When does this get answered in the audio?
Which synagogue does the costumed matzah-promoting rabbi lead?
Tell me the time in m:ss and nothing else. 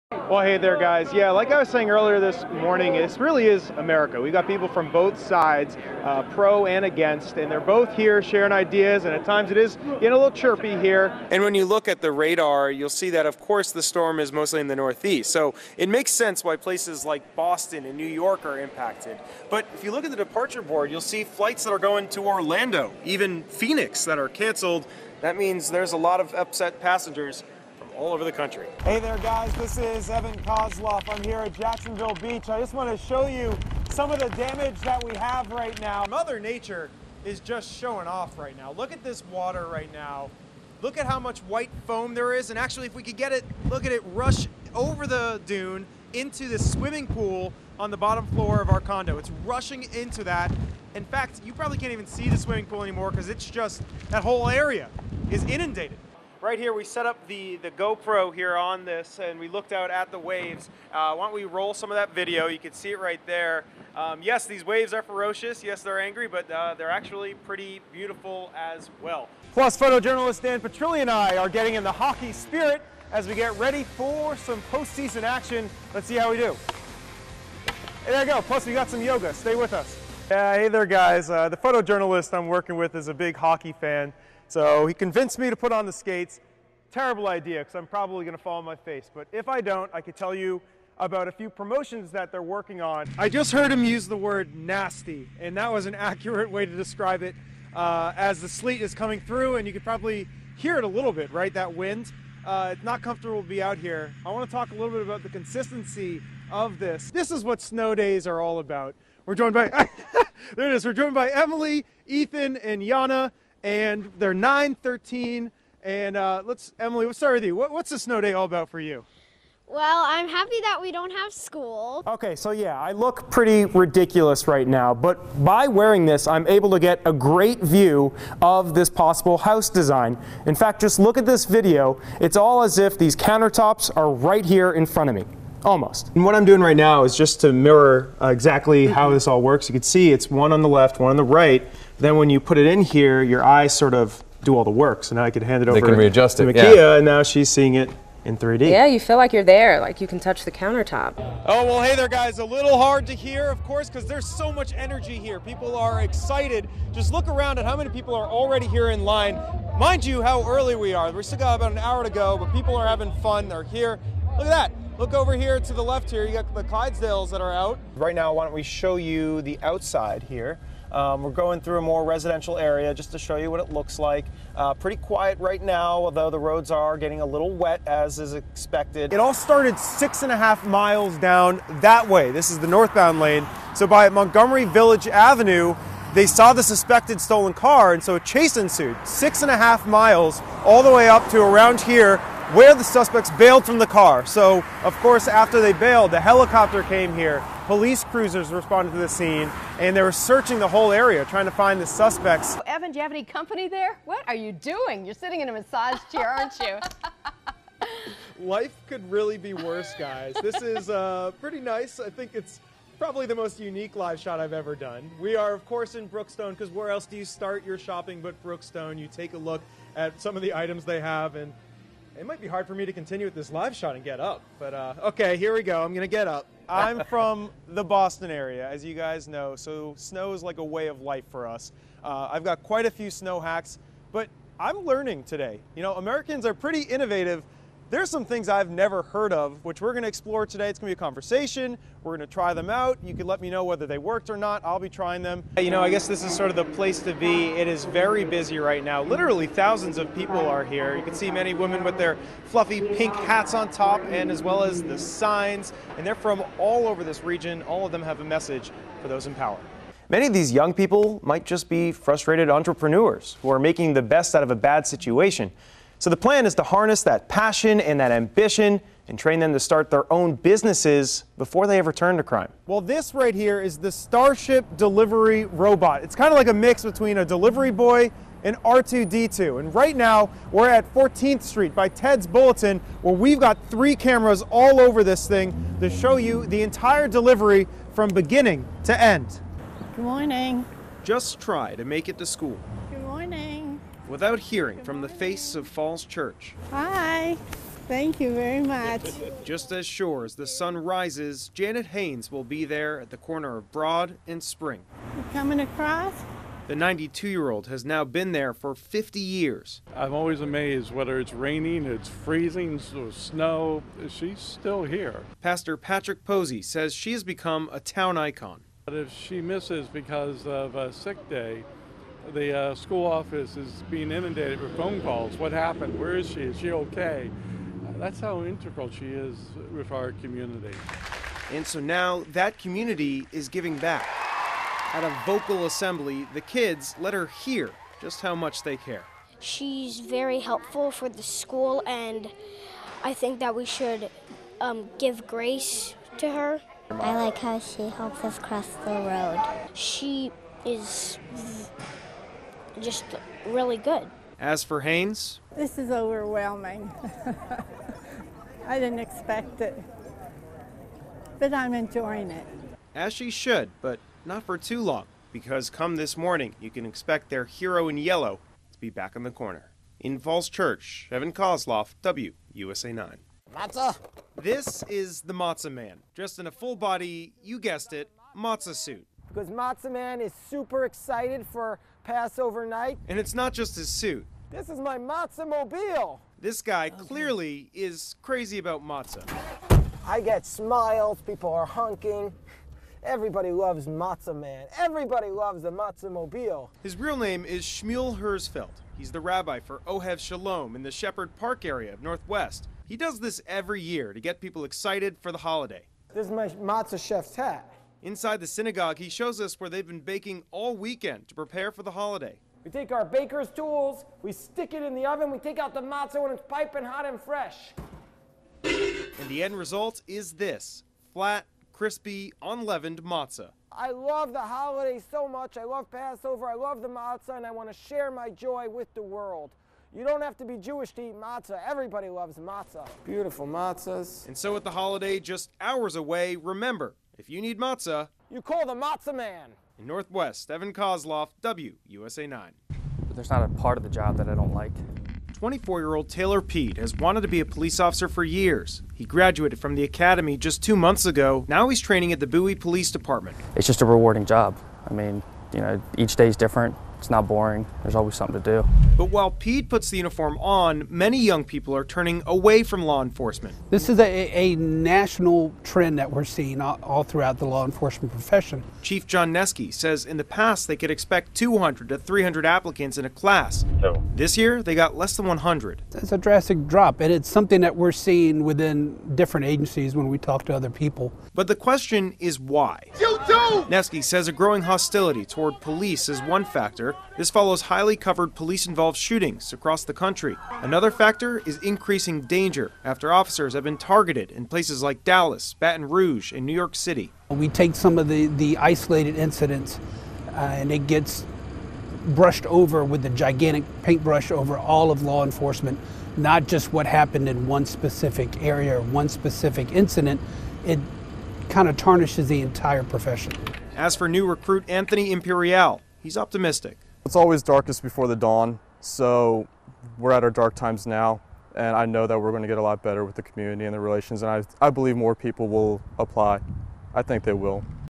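6:39.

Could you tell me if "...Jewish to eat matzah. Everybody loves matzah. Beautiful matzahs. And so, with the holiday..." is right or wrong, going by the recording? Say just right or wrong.
right.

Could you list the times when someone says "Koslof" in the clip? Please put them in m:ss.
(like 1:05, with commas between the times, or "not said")
0:30, 6:11, 7:20.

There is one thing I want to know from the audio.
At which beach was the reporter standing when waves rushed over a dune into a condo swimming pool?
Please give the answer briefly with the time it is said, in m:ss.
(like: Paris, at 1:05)
Jacksonville Beach, at 0:31.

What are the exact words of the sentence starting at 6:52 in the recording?
We take our baker's tools, we stick it in the oven, we take out the matzah when it's piping hot and fresh.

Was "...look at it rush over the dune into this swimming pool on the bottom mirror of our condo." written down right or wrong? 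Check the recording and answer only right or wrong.
wrong.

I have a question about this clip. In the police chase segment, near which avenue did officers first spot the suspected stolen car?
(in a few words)
Montgomery Village Avenue.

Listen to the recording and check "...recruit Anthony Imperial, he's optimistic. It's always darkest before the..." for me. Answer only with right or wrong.
right.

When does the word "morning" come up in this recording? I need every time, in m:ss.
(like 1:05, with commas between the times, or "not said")
0:02, 4:50, 6:06.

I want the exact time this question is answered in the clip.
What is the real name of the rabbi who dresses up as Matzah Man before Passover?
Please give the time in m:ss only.
6:37.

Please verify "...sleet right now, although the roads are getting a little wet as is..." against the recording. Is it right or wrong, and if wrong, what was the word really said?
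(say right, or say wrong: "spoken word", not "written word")
wrong: "quiet", not "sleet".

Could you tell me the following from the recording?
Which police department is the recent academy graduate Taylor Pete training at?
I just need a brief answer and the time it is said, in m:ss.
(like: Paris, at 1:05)
Bowie Police Department, at 7:32.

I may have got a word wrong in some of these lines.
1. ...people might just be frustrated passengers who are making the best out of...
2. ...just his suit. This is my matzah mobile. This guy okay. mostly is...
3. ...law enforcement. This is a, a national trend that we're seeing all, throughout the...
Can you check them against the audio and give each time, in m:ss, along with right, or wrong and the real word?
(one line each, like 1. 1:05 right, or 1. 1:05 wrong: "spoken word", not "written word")
1. 4:20 wrong: "entrepreneurs", not "passengers"
2. 6:23 wrong: "clearly", not "mostly"
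3. 7:42 right.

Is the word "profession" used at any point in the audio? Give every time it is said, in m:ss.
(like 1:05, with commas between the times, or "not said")
7:48, 8:32.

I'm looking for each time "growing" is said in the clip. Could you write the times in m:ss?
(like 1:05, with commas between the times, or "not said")
8:04.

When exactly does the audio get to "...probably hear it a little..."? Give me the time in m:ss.
1:39.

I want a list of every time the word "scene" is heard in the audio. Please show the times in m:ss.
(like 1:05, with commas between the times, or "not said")
3:19.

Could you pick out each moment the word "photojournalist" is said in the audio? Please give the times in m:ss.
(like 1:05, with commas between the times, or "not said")
1:09, 1:21.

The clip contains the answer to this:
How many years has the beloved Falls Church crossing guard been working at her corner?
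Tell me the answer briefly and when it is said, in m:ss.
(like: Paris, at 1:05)
50, at 5:08.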